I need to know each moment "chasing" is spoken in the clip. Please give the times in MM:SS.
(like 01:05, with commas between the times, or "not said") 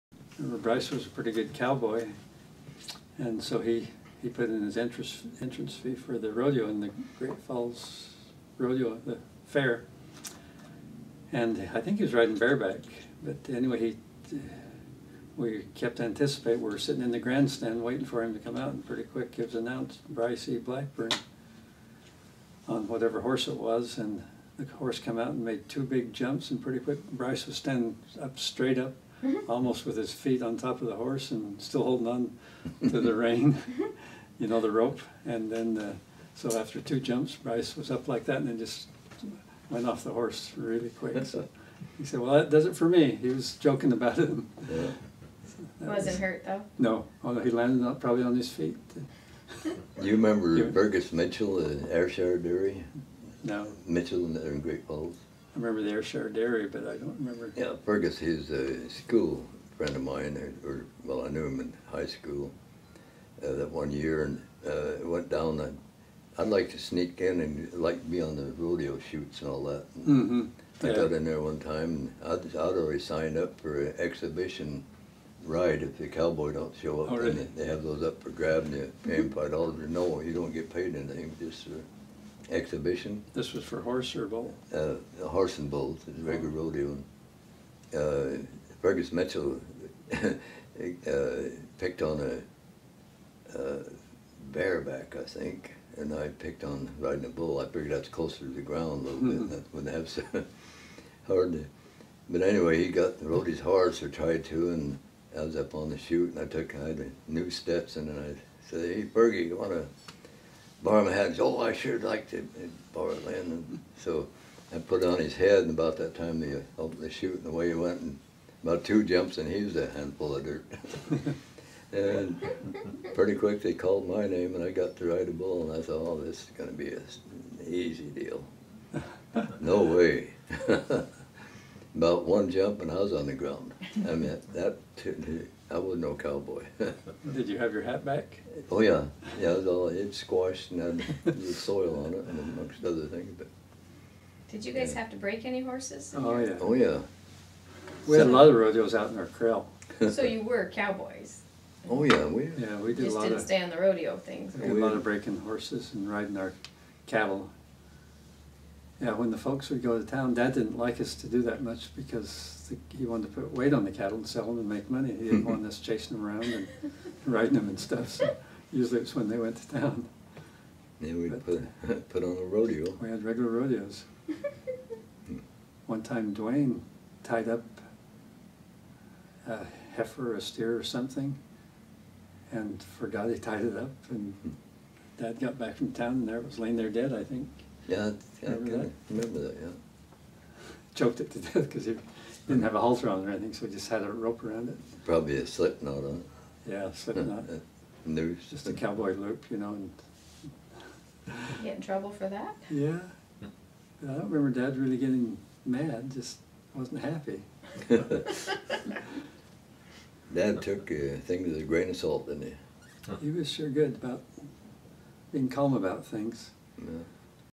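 02:45.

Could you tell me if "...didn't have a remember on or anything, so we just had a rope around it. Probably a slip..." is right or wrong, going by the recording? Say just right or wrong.
wrong.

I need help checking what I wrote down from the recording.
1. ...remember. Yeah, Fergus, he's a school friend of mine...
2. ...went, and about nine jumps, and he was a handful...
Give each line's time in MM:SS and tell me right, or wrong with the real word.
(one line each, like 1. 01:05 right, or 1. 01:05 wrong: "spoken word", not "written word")
1. 00:57 right
2. 01:57 wrong: "two", not "nine".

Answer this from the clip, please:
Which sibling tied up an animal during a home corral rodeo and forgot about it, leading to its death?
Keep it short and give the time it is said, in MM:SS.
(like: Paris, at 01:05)
Dwayne, at 02:56.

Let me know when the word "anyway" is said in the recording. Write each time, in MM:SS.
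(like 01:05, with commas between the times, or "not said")
00:13, 01:42.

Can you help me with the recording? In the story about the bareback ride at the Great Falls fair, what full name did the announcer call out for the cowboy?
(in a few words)
Bryce E. Blackburn.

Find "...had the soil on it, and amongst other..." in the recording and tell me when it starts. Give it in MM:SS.
02:21.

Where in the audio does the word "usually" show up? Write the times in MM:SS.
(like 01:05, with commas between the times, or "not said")
02:48.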